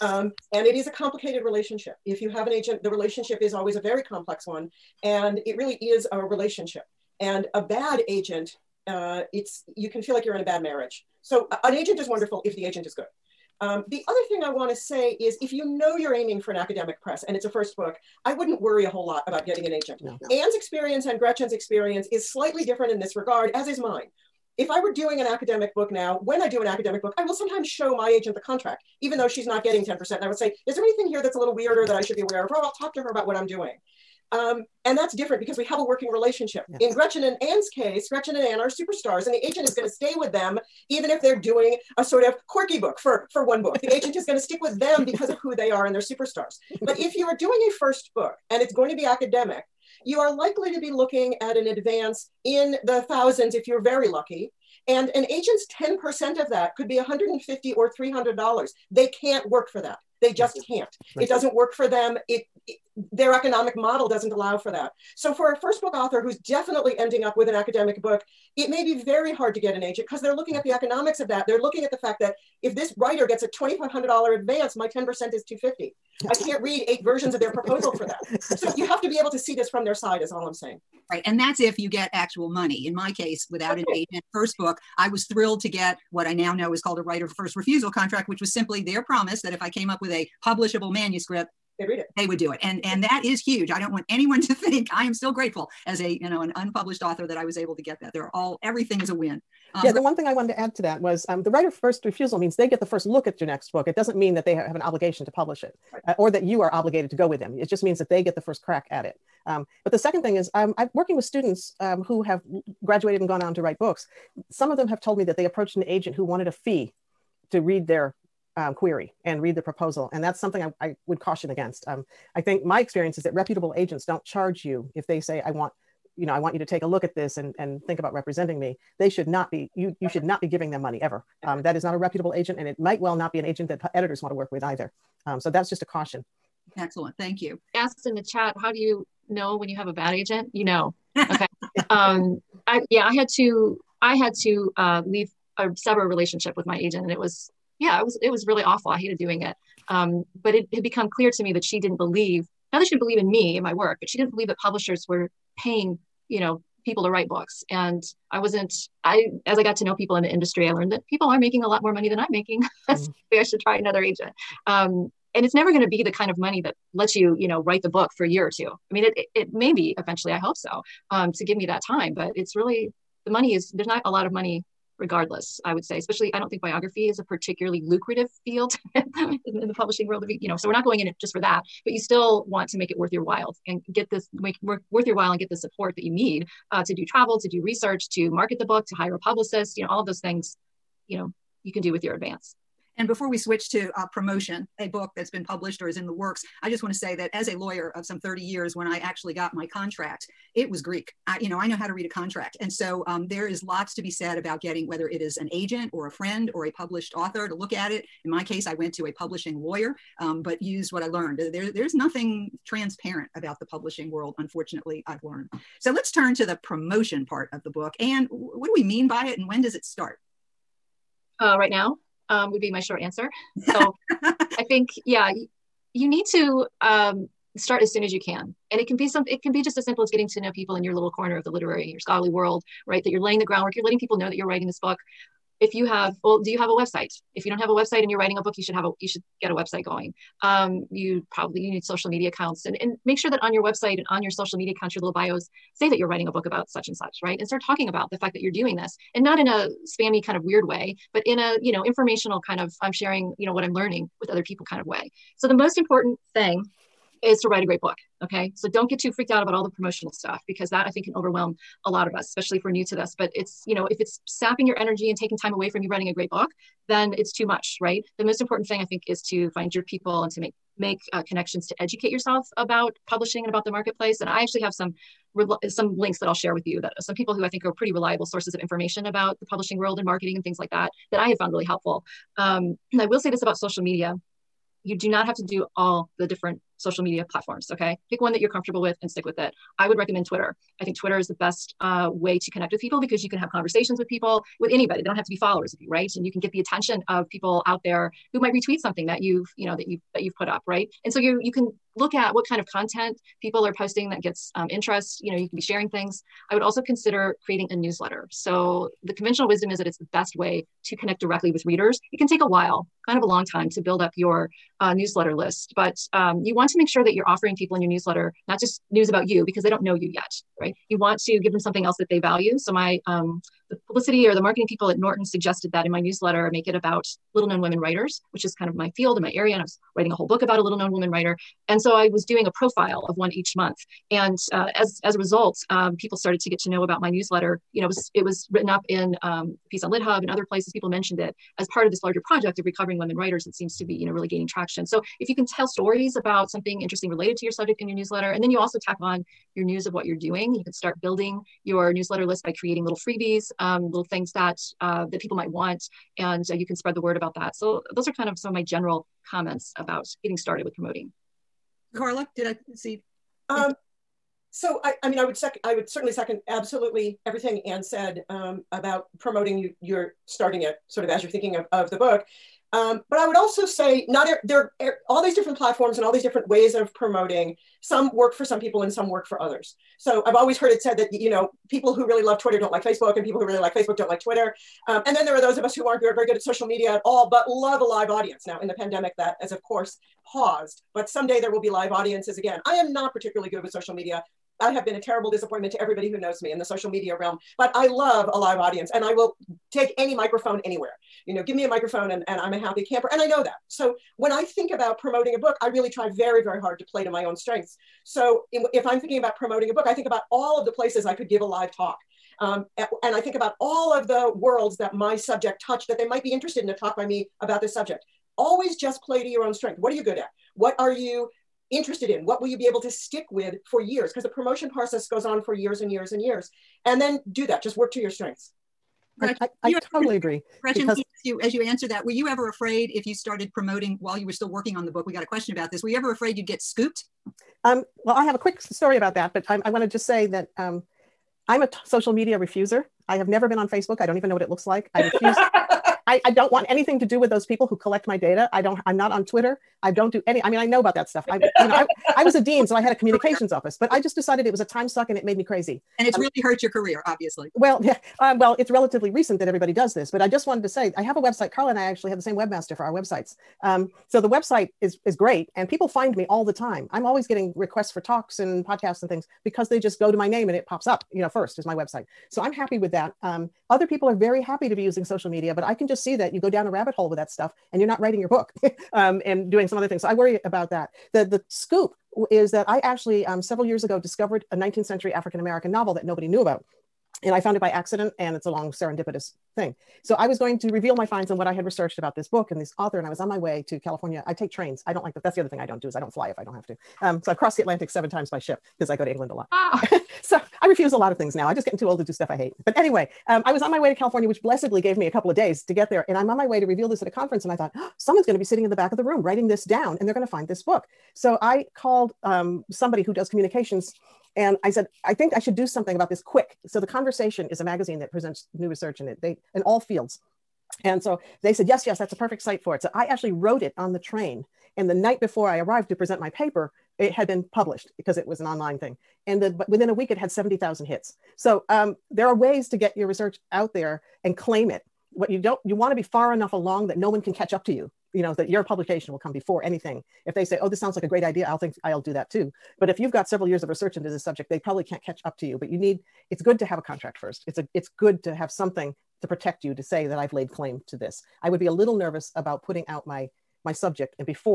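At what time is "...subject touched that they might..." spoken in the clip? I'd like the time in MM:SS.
06:55.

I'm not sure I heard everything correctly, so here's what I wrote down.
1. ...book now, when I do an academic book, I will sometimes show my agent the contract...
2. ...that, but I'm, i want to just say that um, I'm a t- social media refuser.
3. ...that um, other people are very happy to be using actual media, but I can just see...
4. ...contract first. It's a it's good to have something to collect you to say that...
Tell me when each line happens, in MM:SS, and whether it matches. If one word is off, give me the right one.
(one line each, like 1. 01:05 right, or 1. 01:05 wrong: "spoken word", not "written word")
1. 00:25 right
2. 07:19 right
3. 07:52 wrong: "social", not "actual"
4. 09:06 wrong: "protect", not "collect".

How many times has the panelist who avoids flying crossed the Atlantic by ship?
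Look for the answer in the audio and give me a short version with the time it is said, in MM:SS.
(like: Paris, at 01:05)
7, at 08:17.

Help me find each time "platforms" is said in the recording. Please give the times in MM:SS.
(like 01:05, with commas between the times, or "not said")
04:47, 06:15.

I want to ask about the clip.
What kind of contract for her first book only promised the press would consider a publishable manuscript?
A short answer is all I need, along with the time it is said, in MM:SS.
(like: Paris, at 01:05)
right of first refusal, at 01:27.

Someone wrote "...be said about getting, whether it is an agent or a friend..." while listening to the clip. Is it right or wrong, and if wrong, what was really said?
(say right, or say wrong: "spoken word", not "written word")
right.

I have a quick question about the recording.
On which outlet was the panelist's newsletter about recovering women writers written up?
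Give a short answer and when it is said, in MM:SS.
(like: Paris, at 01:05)
LitHub, at 05:39.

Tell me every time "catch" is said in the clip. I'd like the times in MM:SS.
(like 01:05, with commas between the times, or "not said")
08:57, 09:05.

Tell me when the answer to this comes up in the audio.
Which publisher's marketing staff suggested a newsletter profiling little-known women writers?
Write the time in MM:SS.
05:24.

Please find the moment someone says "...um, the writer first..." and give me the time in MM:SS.
01:41.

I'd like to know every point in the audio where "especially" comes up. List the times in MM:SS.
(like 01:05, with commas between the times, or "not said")
02:55, 04:22.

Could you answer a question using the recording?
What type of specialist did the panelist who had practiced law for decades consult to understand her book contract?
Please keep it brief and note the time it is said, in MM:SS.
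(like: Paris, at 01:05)
publishing lawyer, at 03:29.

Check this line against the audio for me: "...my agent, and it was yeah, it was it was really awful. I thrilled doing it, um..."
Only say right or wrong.
wrong.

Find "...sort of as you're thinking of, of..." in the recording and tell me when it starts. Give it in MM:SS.
06:10.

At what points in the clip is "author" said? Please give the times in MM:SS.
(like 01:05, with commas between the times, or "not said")
01:05, 01:37, 03:27, 08:12.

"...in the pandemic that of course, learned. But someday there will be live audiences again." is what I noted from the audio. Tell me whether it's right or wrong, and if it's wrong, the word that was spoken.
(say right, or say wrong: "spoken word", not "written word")
wrong: "paused", not "learned".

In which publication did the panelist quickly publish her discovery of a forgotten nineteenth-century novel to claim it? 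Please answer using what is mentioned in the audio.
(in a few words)
The Conversation.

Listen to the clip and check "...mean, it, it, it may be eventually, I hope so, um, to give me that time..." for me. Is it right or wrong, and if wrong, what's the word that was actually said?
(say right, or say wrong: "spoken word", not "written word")
right.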